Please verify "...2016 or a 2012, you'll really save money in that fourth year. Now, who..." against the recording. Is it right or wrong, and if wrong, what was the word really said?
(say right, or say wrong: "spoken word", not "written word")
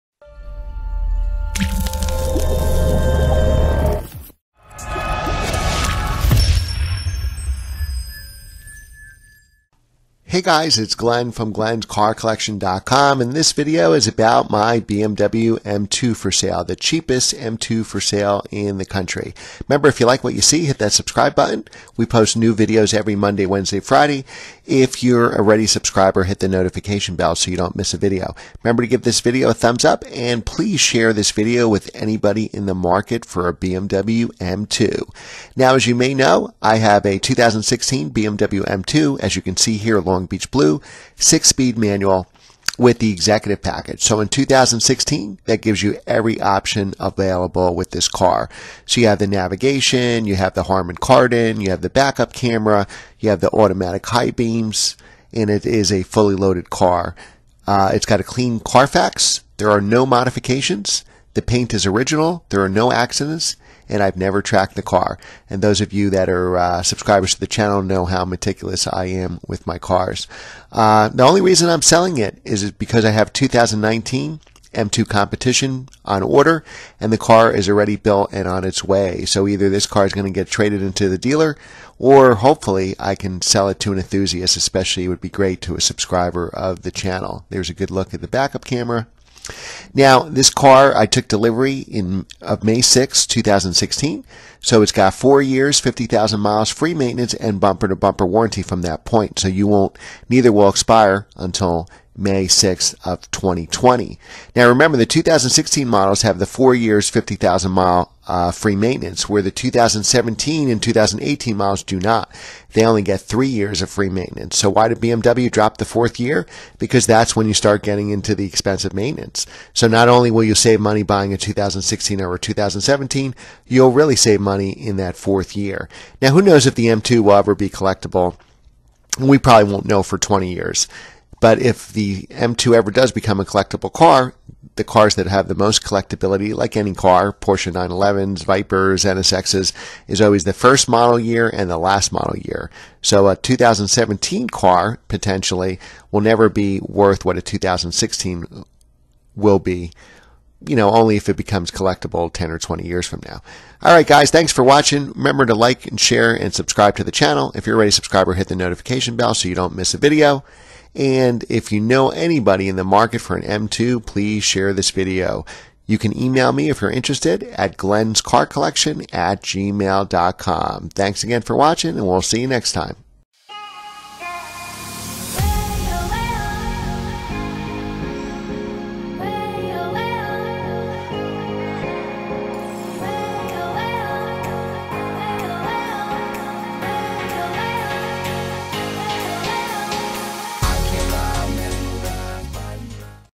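wrong: "2017", not "2012".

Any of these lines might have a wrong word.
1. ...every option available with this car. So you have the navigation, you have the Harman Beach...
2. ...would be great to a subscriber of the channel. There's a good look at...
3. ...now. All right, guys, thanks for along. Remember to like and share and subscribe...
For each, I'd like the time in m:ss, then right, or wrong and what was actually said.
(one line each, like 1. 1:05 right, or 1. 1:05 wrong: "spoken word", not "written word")
1. 0:46 wrong: "Kardon", not "Beach"
2. 1:25 right
3. 2:33 wrong: "watching", not "along".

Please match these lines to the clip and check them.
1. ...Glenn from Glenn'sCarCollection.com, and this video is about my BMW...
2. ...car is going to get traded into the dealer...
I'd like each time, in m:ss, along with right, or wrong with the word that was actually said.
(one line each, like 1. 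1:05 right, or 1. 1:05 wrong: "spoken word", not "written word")
1. 0:10 right
2. 1:19 right.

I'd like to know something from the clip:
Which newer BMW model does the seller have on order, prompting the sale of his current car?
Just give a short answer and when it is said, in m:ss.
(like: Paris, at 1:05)
2019 M2 Competition, at 1:13.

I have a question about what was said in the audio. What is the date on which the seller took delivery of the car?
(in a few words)
May 6, 2016.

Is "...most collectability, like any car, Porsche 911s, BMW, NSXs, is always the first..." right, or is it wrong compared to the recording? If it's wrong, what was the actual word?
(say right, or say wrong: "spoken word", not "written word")
wrong: "Vipers", not "BMW".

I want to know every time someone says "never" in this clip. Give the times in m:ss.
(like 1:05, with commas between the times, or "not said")
1:04, 2:26.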